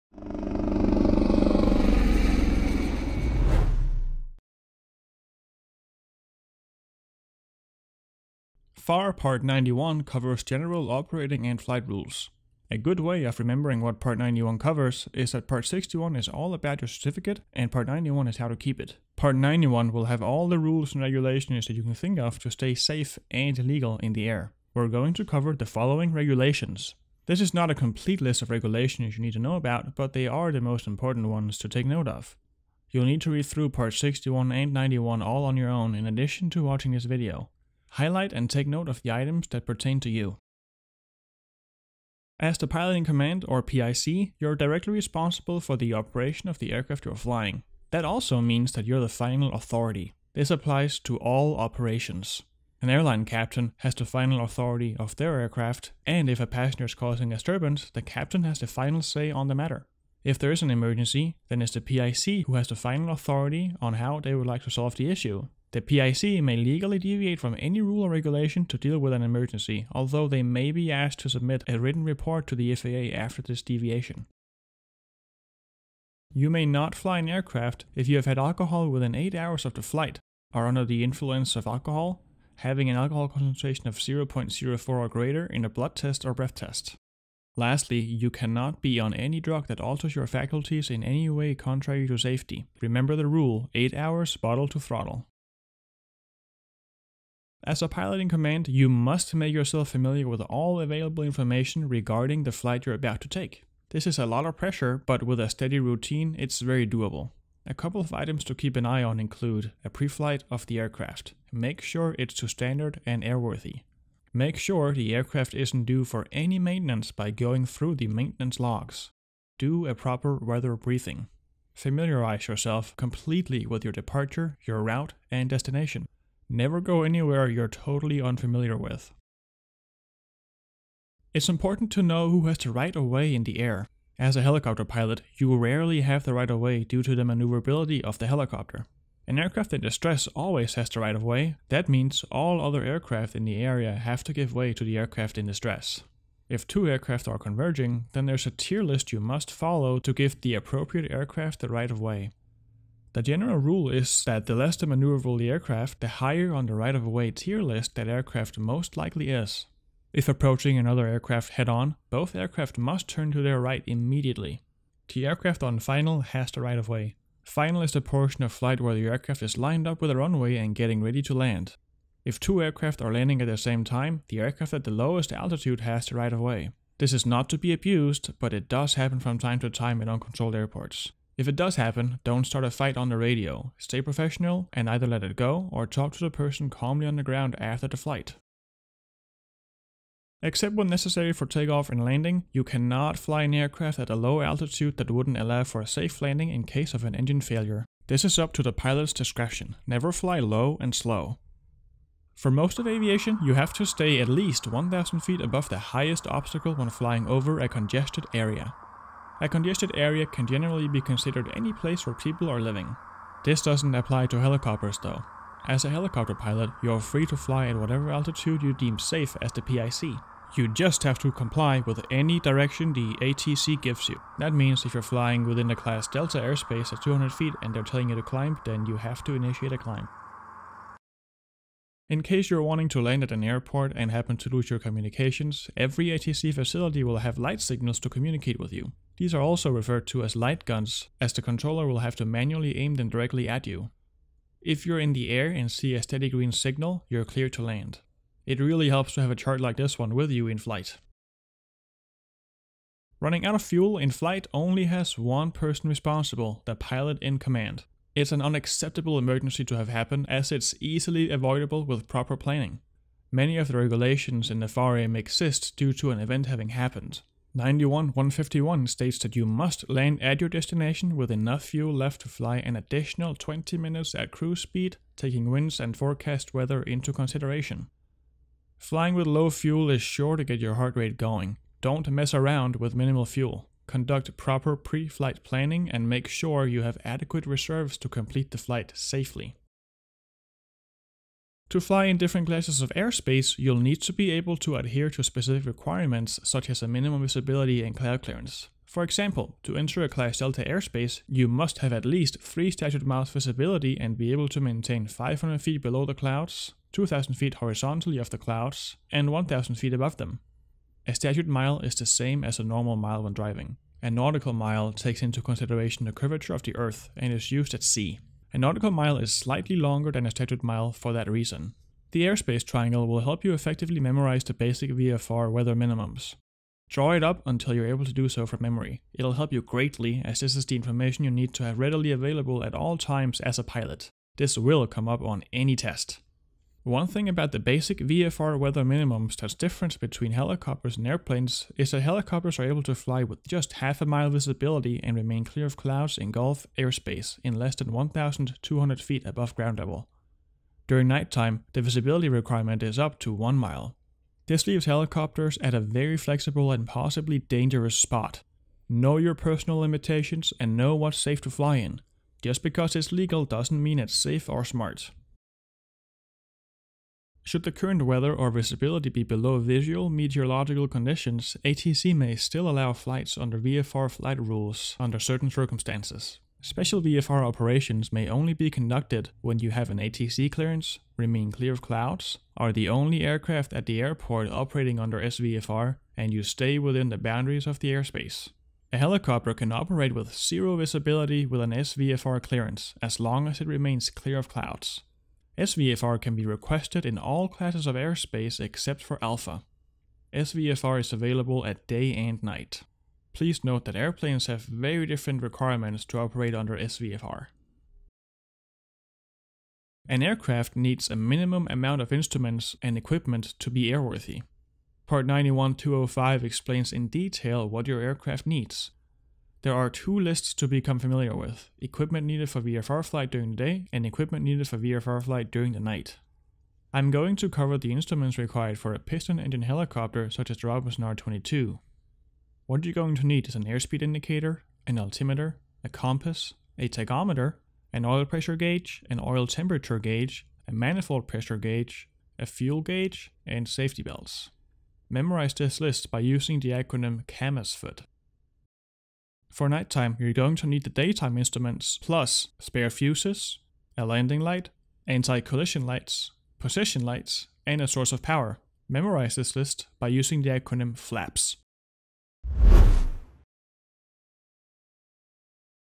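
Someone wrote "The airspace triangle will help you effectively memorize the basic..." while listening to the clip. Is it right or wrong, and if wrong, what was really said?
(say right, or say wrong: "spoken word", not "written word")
right.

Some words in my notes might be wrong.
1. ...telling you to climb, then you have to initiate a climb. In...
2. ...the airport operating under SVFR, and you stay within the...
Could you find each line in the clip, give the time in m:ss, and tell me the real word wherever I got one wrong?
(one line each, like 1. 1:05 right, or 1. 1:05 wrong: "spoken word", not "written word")
1. 3:47 right
2. 6:23 right.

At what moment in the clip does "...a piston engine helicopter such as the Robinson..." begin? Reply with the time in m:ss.
7:08.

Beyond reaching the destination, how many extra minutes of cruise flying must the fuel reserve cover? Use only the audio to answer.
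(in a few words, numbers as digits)
20.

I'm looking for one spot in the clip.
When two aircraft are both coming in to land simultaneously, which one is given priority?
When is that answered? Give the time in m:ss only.
2:54.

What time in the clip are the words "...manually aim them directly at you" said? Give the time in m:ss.
4:02.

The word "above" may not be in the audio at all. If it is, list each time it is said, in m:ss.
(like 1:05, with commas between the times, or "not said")
3:25, 5:09, 5:49.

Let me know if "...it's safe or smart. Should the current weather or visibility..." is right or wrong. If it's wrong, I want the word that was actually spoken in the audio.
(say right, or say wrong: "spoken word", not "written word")
right.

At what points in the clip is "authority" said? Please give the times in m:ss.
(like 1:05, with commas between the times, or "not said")
0:49, 0:54, 1:03.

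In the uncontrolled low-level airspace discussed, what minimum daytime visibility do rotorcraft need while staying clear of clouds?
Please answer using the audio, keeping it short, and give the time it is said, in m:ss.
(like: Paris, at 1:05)
half a mile, at 5:43.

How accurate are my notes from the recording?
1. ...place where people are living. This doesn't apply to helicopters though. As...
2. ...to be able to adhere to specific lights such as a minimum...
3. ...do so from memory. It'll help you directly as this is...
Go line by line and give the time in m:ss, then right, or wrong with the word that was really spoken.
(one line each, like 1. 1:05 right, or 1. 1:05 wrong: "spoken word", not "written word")
1. 3:31 right
2. 4:54 wrong: "requirements", not "lights"
3. 5:28 wrong: "greatly", not "directly".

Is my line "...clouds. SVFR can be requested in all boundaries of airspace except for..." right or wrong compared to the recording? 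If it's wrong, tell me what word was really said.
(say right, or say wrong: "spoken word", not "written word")
wrong: "classes", not "boundaries".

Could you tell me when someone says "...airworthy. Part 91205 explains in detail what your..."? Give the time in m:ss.
6:53.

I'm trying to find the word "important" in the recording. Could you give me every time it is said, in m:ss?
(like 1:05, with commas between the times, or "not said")
0:30, 2:11.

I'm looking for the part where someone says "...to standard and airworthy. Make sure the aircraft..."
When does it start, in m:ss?
1:52.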